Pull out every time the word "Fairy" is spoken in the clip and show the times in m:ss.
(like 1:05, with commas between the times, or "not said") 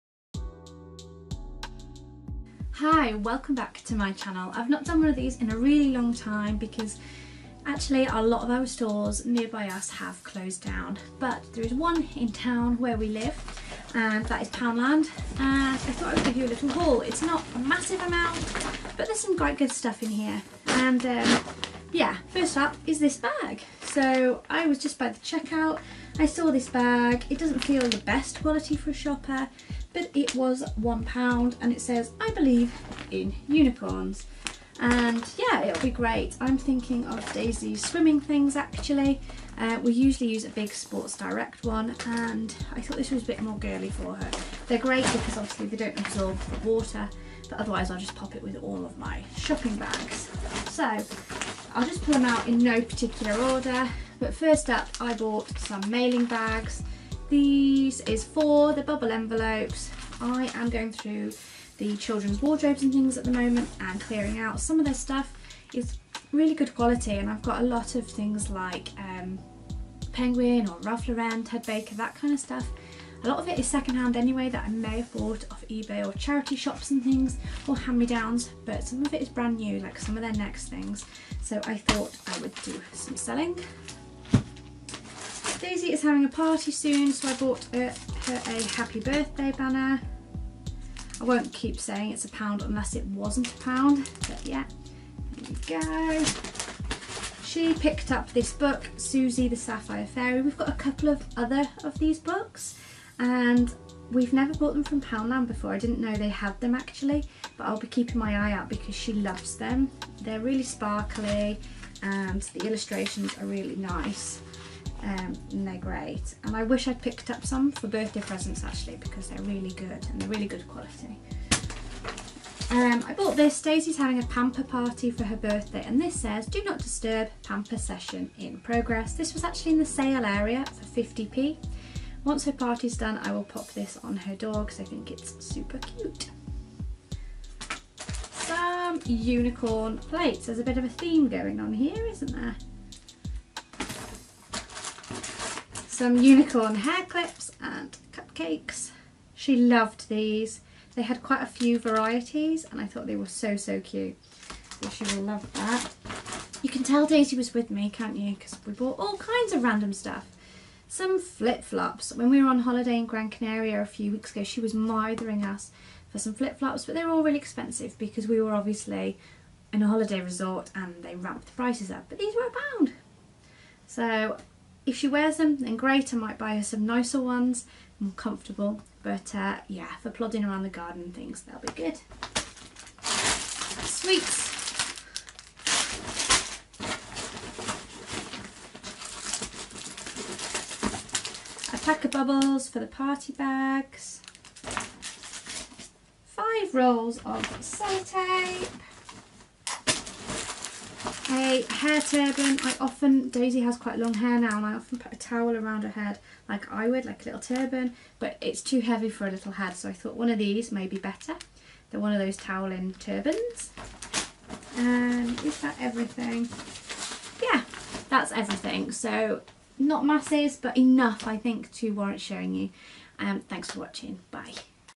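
1:40.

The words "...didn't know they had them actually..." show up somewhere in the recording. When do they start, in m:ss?
1:45.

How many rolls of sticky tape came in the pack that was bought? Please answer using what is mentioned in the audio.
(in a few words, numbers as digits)
5.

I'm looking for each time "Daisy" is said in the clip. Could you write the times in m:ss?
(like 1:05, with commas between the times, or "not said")
0:37, 1:25, 2:03, 2:37, 3:23.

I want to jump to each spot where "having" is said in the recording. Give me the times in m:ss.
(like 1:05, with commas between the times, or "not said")
1:26, 2:03.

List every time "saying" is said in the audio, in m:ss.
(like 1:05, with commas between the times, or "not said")
1:31.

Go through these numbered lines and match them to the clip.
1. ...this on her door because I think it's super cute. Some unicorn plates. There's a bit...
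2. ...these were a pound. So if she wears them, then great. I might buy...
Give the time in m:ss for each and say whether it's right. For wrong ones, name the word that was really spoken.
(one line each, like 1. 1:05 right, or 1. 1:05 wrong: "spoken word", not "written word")
1. 2:13 right
2. 2:52 right.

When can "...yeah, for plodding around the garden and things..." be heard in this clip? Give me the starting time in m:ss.
2:59.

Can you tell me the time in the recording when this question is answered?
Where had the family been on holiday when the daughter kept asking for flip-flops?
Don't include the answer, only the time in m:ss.
2:43.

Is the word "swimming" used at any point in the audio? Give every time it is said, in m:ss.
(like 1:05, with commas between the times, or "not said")
0:37.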